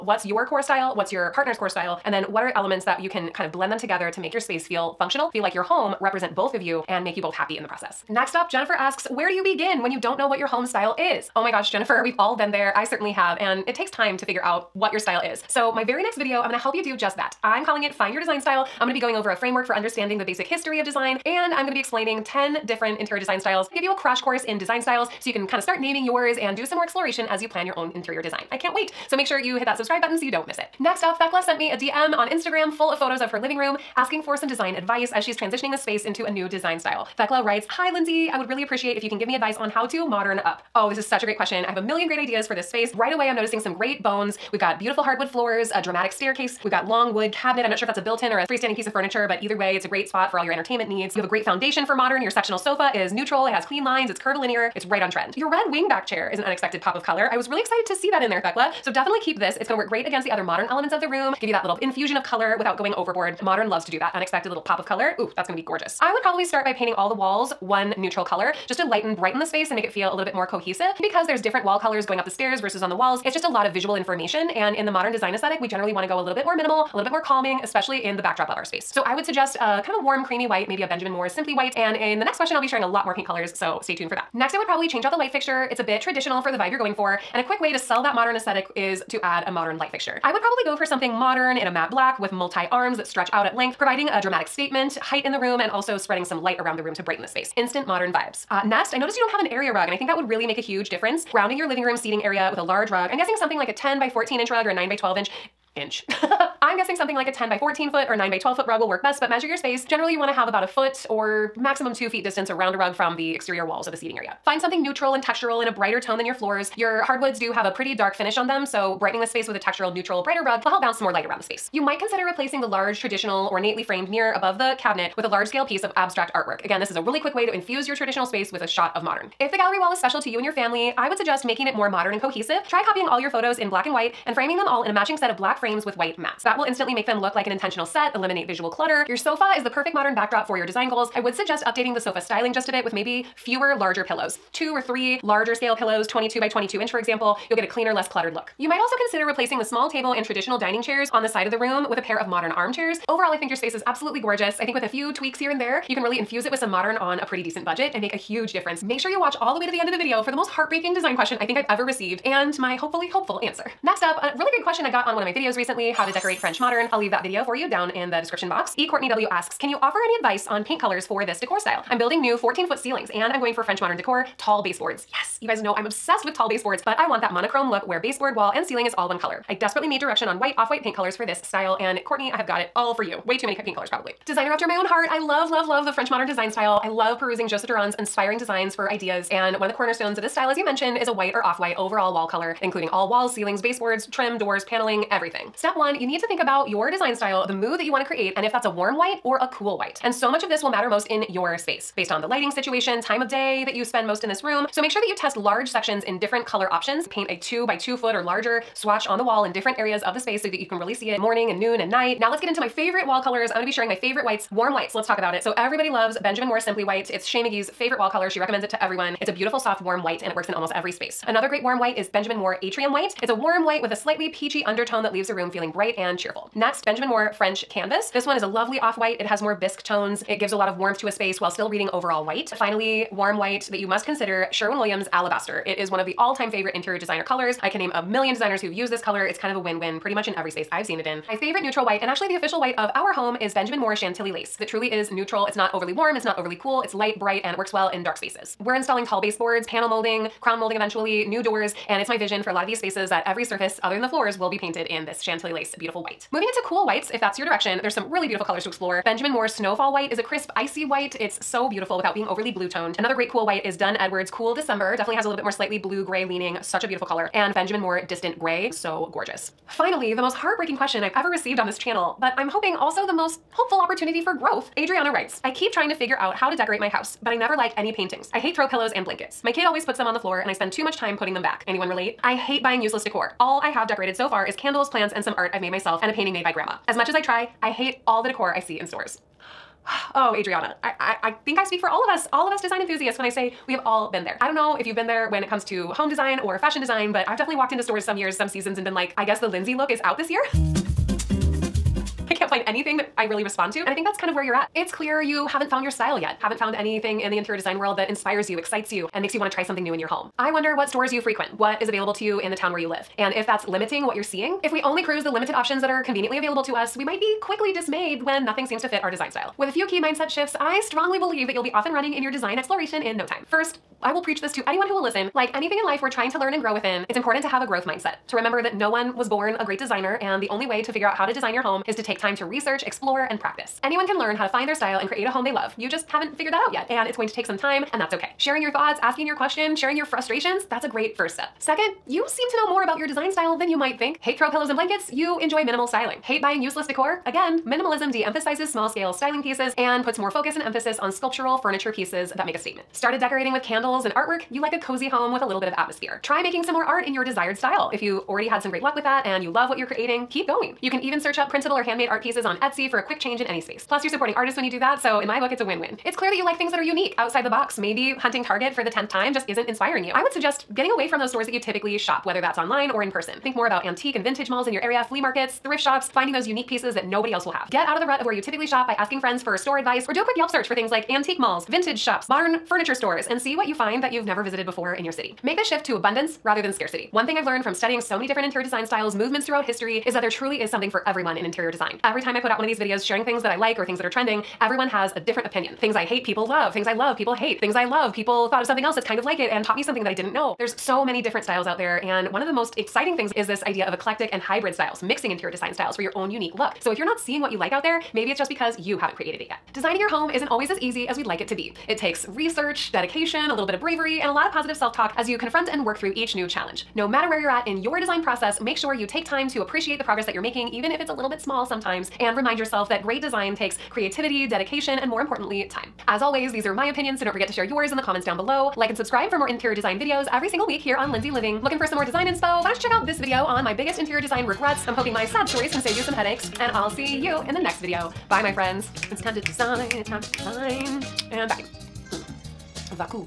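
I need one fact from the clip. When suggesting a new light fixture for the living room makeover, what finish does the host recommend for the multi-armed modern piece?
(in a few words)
matte black.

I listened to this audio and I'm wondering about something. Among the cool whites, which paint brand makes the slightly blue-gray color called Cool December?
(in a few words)
Dunn Edwards.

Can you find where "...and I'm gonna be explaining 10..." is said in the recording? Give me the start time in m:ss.
0:21.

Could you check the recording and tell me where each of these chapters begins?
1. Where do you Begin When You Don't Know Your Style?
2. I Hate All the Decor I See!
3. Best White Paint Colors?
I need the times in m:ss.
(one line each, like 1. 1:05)
1. 0:12
2. 4:40
3. 2:48.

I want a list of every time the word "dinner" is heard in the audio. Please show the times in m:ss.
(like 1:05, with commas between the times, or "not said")
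not said.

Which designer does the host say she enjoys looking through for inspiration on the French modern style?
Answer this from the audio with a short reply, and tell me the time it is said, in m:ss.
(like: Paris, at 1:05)
Joseph Dirand, at 3:07.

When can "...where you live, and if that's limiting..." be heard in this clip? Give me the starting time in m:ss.
5:12.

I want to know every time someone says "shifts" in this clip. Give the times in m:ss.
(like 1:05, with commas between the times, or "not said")
5:20, 6:25.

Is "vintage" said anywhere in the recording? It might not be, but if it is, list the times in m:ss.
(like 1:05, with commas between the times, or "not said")
6:14, 6:21.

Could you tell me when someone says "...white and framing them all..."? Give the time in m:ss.
2:13.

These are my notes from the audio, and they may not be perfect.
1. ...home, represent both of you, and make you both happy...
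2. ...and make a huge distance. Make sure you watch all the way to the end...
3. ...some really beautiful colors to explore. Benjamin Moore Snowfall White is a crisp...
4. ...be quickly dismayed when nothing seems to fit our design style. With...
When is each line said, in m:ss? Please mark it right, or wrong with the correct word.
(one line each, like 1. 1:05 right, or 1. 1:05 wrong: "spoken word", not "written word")
1. 0:05 right
2. 2:37 wrong: "difference", not "distance"
3. 4:17 right
4. 5:17 right.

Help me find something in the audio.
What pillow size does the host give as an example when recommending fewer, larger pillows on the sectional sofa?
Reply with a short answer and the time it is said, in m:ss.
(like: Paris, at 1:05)
22 by 22 inch, at 2:26.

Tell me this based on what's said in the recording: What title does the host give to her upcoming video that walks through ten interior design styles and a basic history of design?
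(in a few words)
Find Your Design Style.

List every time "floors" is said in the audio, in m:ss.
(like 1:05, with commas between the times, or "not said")
0:45, 1:56, 4:14, 4:40.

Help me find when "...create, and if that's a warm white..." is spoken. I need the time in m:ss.
3:18.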